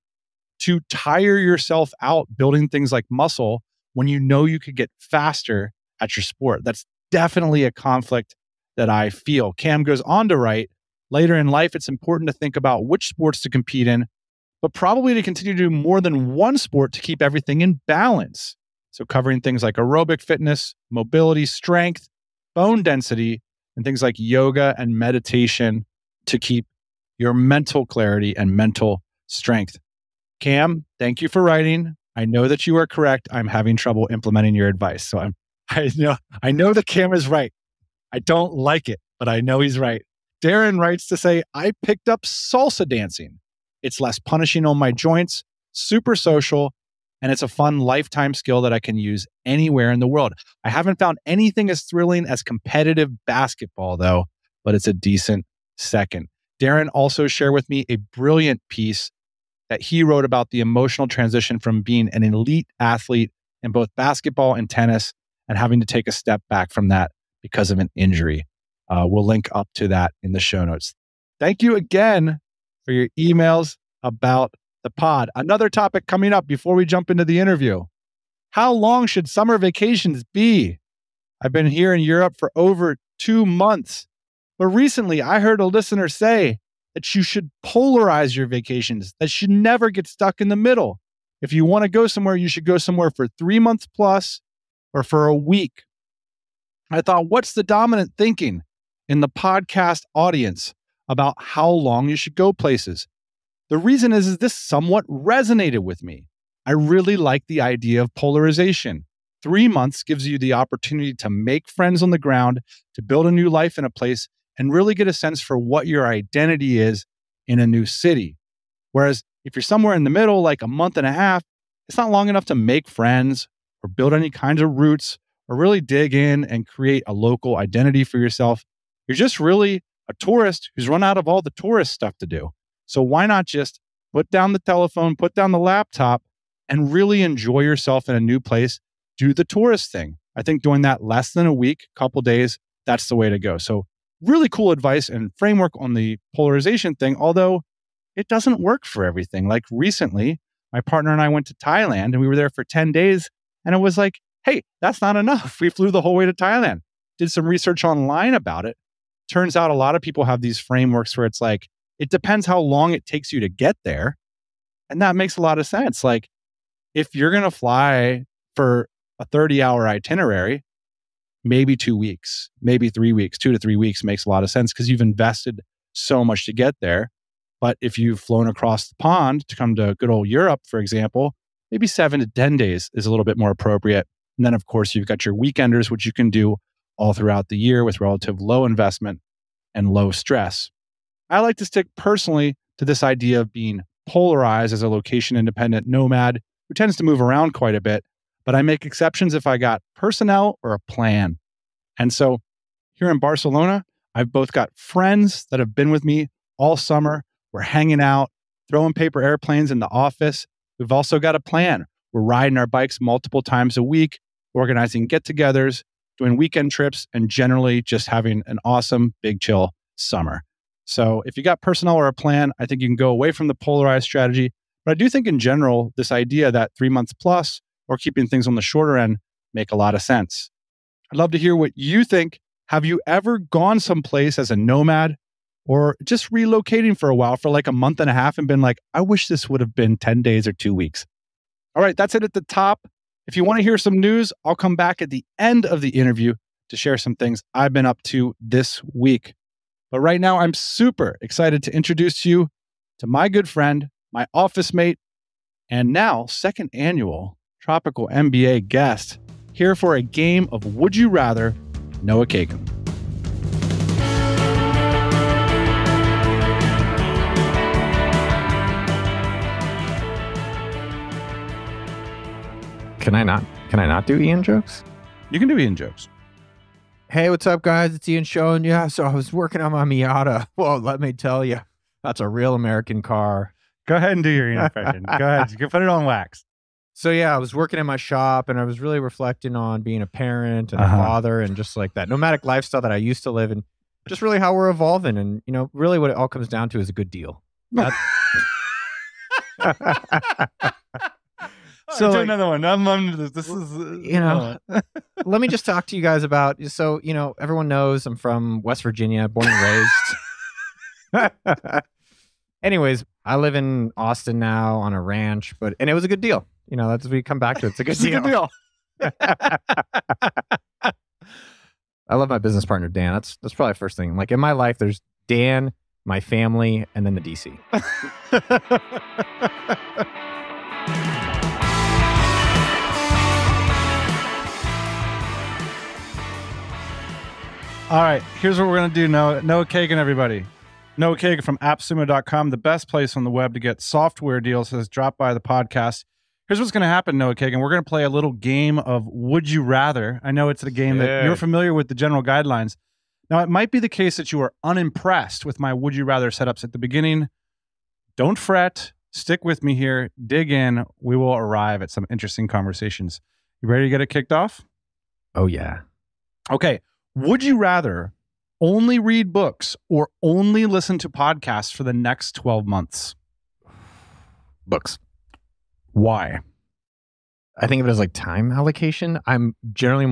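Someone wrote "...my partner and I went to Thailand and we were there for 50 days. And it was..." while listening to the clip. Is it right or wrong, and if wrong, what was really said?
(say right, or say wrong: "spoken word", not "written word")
wrong: "10", not "50".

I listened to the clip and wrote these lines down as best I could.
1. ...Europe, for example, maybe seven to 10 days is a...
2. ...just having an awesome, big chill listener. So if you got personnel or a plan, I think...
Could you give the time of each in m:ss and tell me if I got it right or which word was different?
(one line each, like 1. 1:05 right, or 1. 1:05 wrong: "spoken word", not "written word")
1. 3:00 right
2. 3:37 wrong: "summer", not "listener".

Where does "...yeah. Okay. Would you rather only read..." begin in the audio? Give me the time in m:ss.
6:05.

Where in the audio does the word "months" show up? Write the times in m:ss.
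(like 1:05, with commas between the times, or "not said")
1:23, 1:33, 1:49, 2:00, 3:46, 3:57, 6:12.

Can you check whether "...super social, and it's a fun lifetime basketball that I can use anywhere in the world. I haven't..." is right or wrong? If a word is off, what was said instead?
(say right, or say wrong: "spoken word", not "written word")
wrong: "skill", not "basketball".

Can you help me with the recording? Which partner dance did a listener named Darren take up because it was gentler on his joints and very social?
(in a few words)
Salsa dancing.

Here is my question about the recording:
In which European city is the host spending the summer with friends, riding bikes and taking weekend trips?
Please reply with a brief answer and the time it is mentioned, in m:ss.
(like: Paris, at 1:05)
Barcelona, at 3:23.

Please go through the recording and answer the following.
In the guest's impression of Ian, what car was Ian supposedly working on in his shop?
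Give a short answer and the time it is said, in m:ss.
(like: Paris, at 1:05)
Miata, at 4:39.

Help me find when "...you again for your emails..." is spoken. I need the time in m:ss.
1:11.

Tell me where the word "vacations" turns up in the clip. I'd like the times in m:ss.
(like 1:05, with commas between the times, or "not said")
1:19, 1:28.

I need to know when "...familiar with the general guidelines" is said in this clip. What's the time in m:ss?
5:51.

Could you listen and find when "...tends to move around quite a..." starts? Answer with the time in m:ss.
3:16.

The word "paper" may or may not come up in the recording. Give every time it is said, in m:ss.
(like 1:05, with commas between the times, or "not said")
3:28.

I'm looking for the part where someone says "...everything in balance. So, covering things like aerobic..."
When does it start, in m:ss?
0:17.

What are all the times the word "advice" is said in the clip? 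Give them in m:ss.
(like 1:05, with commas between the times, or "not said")
0:34, 2:24.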